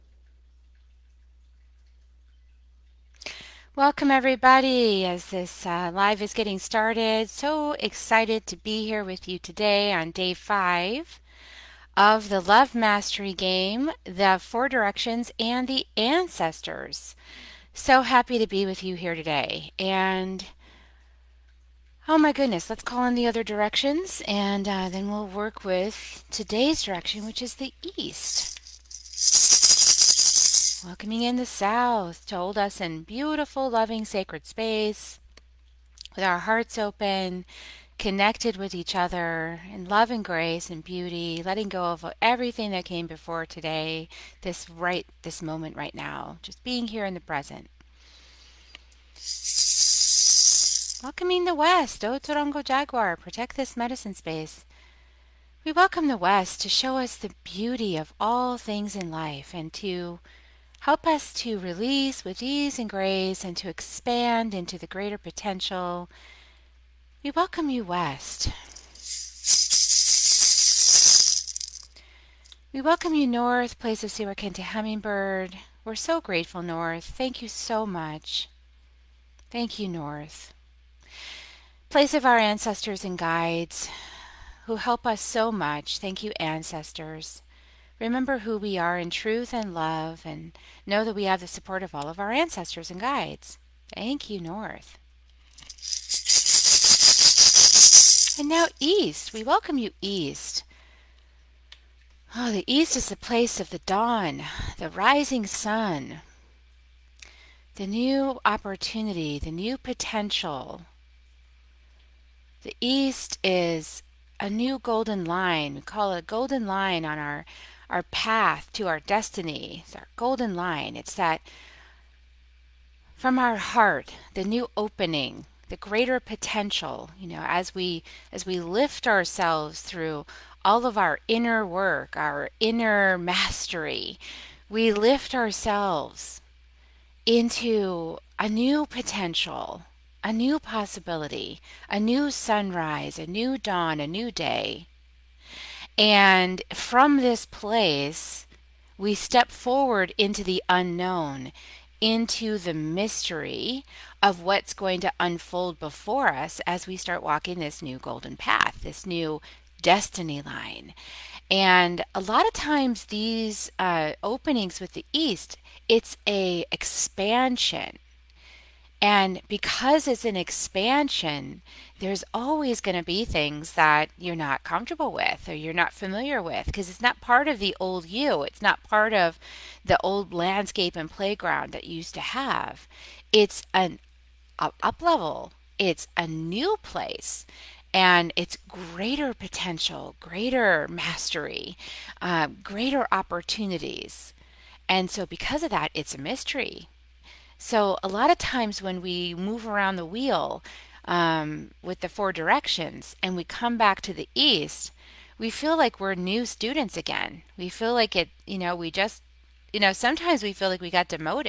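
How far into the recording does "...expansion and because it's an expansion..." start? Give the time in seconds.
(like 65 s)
166 s.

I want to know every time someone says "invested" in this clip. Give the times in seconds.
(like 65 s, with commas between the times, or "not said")
not said.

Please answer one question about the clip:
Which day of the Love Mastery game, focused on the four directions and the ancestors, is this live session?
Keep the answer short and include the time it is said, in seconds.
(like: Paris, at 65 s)
Day 5, at 10 s.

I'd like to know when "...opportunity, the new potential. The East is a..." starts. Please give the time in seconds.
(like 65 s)
108 s.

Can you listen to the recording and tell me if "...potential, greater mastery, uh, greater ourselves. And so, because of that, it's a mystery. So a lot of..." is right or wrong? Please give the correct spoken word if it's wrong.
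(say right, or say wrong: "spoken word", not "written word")
wrong: "opportunities", not "ourselves".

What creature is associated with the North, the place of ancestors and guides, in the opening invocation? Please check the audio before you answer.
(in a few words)
Hummingbird.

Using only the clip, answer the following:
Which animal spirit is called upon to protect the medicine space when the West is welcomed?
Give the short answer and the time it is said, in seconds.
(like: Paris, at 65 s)
Otorongo Jaguar, at 52 s.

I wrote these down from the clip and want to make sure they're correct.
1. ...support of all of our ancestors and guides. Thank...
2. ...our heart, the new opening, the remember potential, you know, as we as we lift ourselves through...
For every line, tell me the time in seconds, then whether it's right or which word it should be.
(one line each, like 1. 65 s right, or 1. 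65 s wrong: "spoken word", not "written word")
1. 91 s right
2. 123 s wrong: "greater", not "remember".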